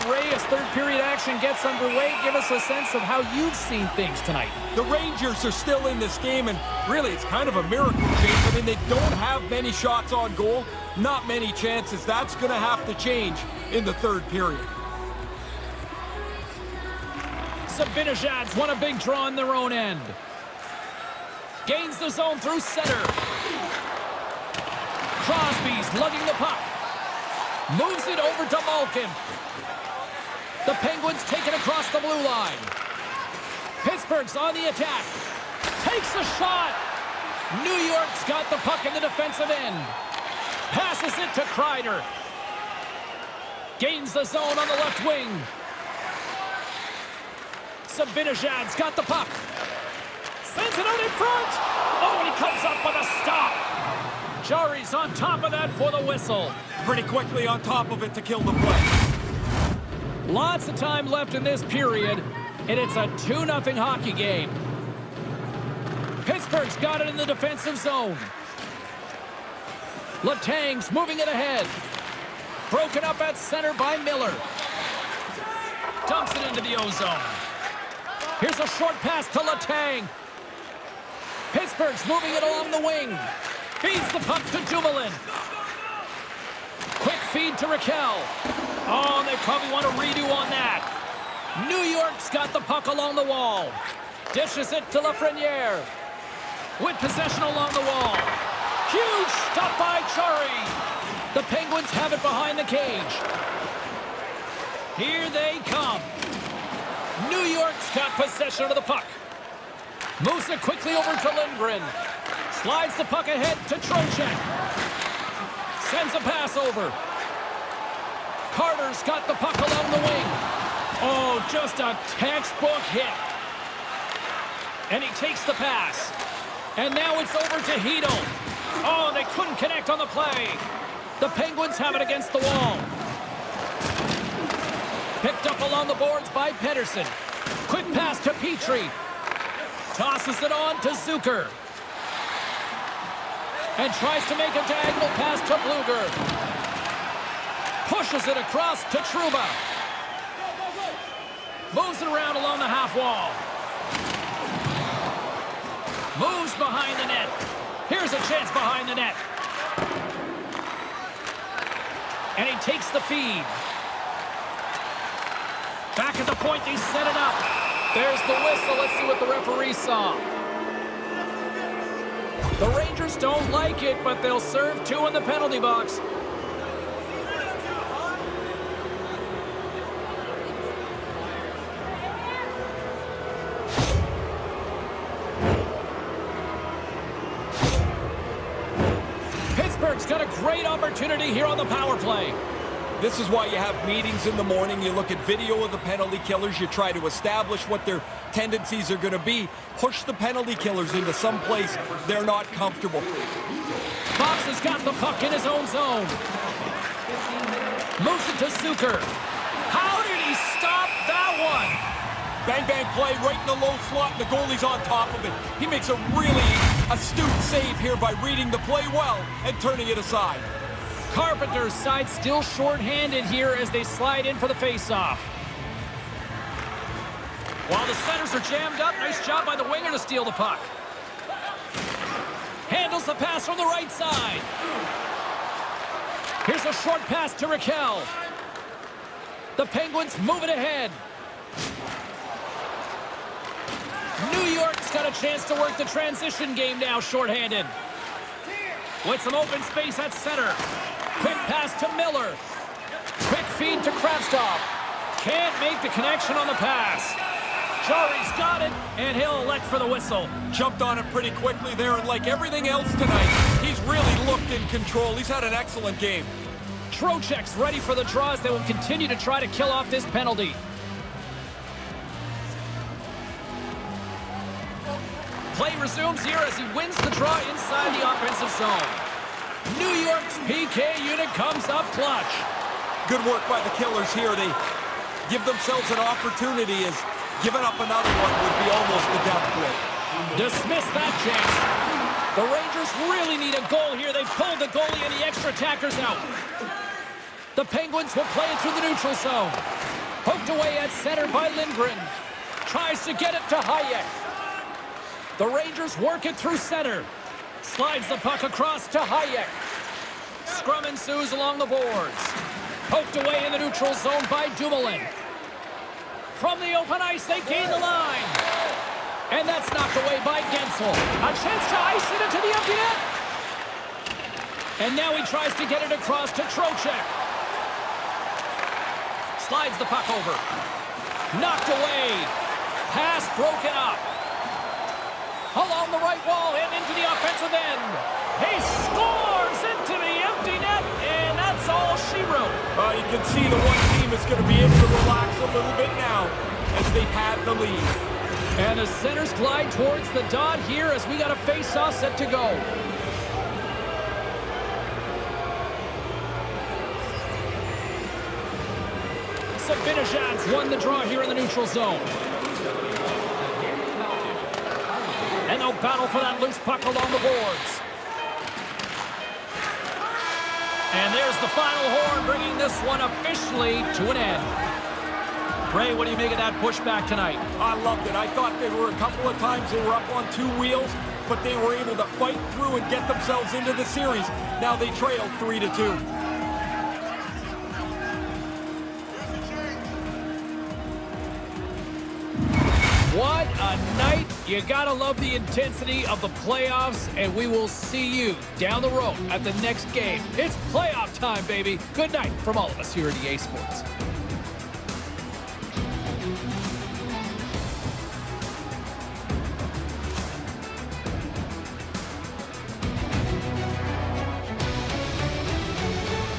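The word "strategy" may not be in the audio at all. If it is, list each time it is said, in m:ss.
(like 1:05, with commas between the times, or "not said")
not said.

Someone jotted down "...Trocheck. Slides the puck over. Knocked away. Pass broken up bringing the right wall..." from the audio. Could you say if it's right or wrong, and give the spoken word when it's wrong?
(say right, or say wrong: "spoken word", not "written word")
wrong: "along", not "bringing".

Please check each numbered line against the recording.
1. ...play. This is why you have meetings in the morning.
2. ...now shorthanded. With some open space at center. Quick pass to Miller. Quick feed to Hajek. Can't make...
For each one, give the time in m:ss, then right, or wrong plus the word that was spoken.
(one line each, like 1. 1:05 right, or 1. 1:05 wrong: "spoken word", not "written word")
1. 3:11 right
2. 4:06 wrong: "Kravtsov", not "Hajek".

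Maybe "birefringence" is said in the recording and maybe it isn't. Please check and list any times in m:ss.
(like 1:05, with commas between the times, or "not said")
not said.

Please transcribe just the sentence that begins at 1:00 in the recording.
Lots of time left in this period, and it's a 2-0 hockey game.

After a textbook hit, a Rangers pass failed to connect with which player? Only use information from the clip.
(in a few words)
Hedo.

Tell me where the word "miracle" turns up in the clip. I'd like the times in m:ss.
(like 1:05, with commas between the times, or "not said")
0:07.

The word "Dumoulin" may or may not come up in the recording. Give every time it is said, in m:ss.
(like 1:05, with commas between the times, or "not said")
1:24, 5:14.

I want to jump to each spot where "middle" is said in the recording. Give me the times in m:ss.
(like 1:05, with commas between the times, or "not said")
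not said.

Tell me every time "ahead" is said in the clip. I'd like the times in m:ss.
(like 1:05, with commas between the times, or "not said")
1:11, 1:53, 4:00.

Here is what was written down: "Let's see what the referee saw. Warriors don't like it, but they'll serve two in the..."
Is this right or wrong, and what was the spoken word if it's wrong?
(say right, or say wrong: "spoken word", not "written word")
right.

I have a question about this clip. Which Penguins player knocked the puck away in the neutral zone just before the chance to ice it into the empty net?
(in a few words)
Guentzel.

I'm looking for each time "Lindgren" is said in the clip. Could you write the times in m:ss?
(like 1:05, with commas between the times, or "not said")
1:51, 5:01.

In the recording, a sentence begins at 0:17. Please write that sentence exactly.
Zibanejad's won a big draw on their own end.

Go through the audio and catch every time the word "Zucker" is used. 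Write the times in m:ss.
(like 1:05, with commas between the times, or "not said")
2:20, 3:28.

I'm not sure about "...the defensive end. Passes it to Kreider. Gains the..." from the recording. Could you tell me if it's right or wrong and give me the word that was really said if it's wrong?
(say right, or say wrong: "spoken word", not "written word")
right.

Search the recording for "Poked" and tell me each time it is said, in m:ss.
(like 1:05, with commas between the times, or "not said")
5:00, 5:12.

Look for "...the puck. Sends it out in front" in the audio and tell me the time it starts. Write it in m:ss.
0:48.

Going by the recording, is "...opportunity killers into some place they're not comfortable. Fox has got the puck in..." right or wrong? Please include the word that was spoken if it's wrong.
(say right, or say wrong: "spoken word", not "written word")
wrong: "penalty", not "opportunity".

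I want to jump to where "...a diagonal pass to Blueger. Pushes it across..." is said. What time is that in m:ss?
2:24.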